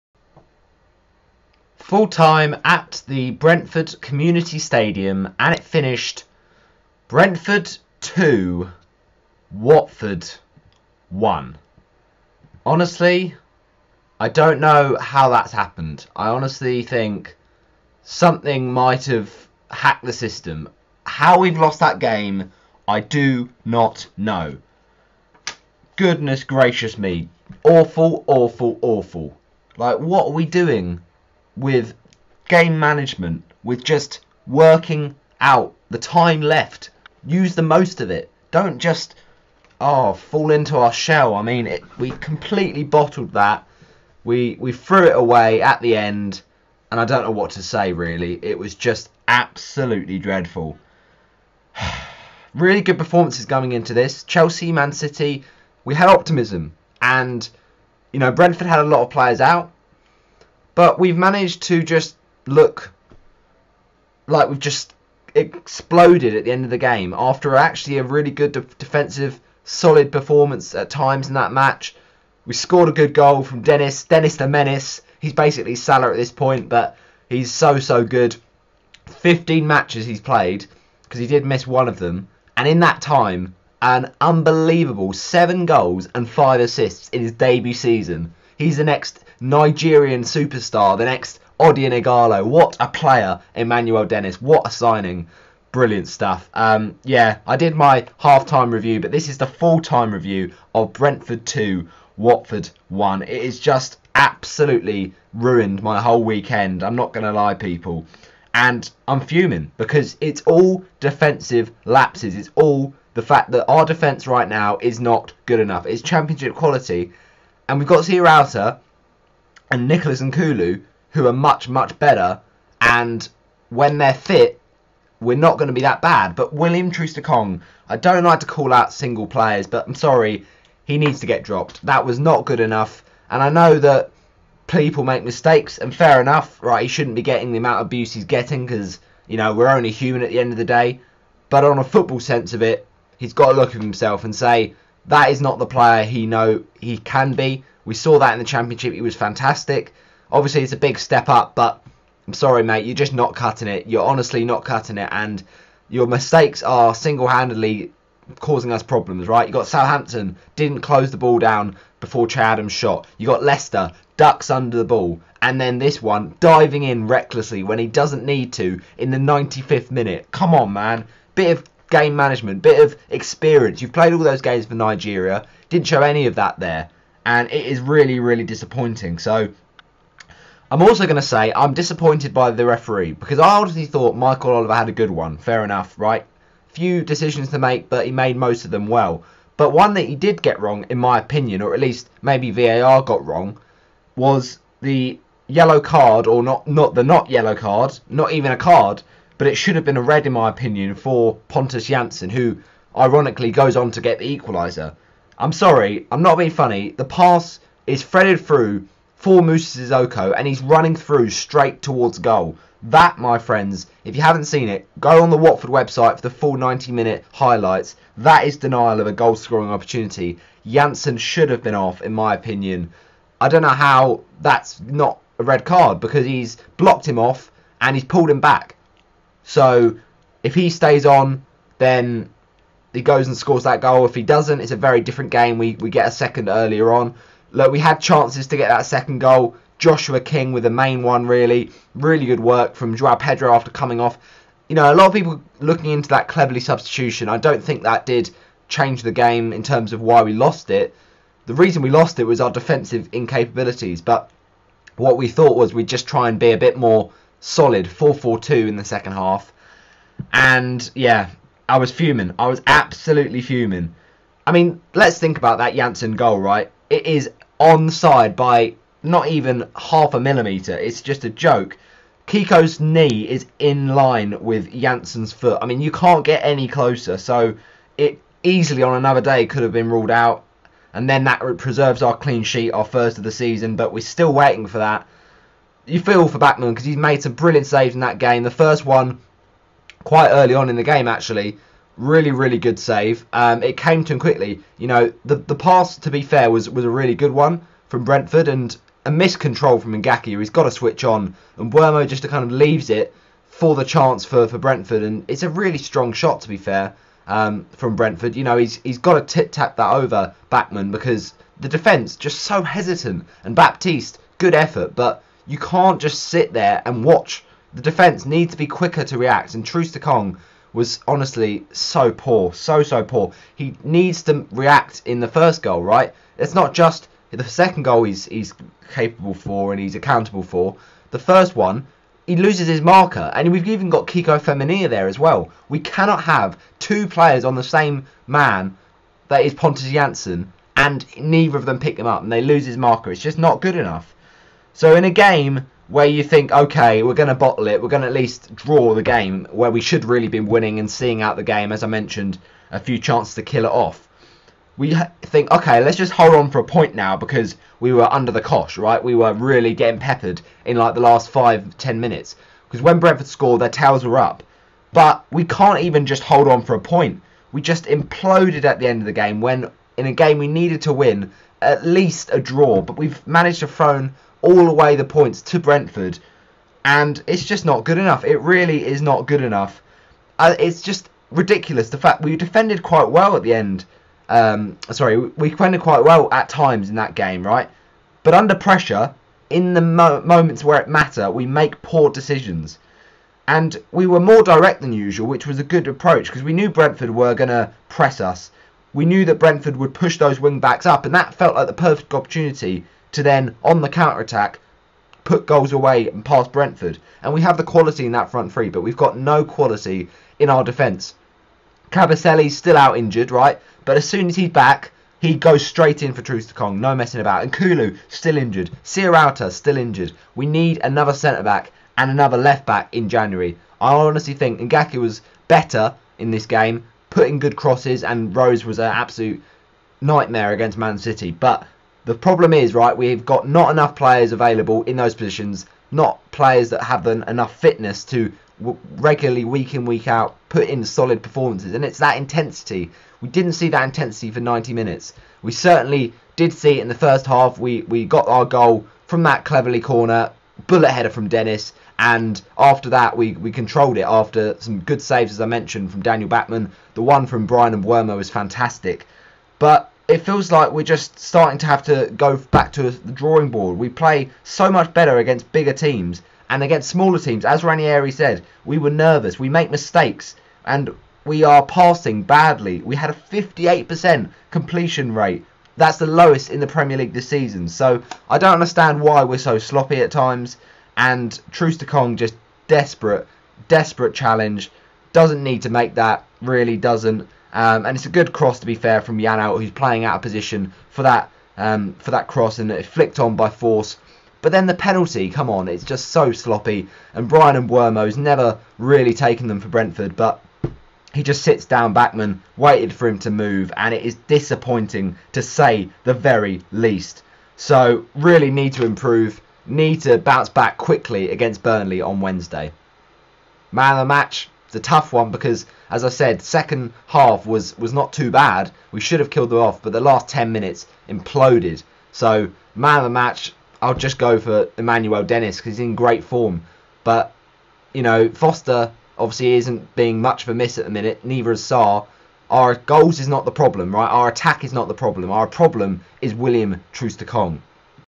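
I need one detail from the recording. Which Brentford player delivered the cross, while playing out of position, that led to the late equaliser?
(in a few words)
Janelt.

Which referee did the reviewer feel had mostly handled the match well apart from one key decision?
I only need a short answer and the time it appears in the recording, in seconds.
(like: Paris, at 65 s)
Michael Oliver, at 184 s.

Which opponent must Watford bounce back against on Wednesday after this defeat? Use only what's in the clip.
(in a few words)
Burnley.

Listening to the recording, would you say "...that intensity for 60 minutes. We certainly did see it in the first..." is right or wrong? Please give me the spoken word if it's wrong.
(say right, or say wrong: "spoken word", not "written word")
wrong: "90", not "60".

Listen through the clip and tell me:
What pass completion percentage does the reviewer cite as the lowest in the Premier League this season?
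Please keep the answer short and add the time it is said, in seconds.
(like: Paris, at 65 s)
58%, at 473 s.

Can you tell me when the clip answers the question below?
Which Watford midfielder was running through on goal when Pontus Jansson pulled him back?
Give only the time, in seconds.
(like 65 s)
209 s.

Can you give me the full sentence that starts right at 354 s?
We think, okay, let's just hold on for a point now because we were under the cosh, right?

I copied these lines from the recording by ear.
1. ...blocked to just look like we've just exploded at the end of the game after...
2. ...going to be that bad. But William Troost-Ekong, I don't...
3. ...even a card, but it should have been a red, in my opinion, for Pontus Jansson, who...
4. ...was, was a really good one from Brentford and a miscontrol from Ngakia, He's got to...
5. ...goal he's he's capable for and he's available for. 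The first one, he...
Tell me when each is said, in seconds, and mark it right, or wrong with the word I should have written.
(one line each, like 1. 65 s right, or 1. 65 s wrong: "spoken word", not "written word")
1. 61 s wrong: "managed", not "blocked"
2. 125 s right
3. 198 s right
4. 296 s right
5. 327 s wrong: "accountable", not "available".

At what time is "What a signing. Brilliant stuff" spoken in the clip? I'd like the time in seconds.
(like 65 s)
94 s.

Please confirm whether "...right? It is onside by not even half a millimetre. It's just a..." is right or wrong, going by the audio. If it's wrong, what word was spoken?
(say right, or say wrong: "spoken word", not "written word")
right.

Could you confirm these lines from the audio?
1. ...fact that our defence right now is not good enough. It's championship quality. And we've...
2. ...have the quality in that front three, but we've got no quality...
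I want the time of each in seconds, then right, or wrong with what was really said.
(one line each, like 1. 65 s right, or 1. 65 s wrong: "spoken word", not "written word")
1. 113 s right
2. 407 s right.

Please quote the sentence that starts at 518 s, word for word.
We should have killed them off, but the last 10 minutes imploded.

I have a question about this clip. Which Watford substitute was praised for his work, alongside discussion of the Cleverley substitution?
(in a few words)
Joao Pedro.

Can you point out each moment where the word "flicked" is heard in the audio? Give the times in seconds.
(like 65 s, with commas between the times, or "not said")
492 s.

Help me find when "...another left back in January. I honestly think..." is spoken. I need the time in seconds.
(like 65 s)
422 s.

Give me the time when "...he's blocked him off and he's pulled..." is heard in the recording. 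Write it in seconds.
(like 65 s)
226 s.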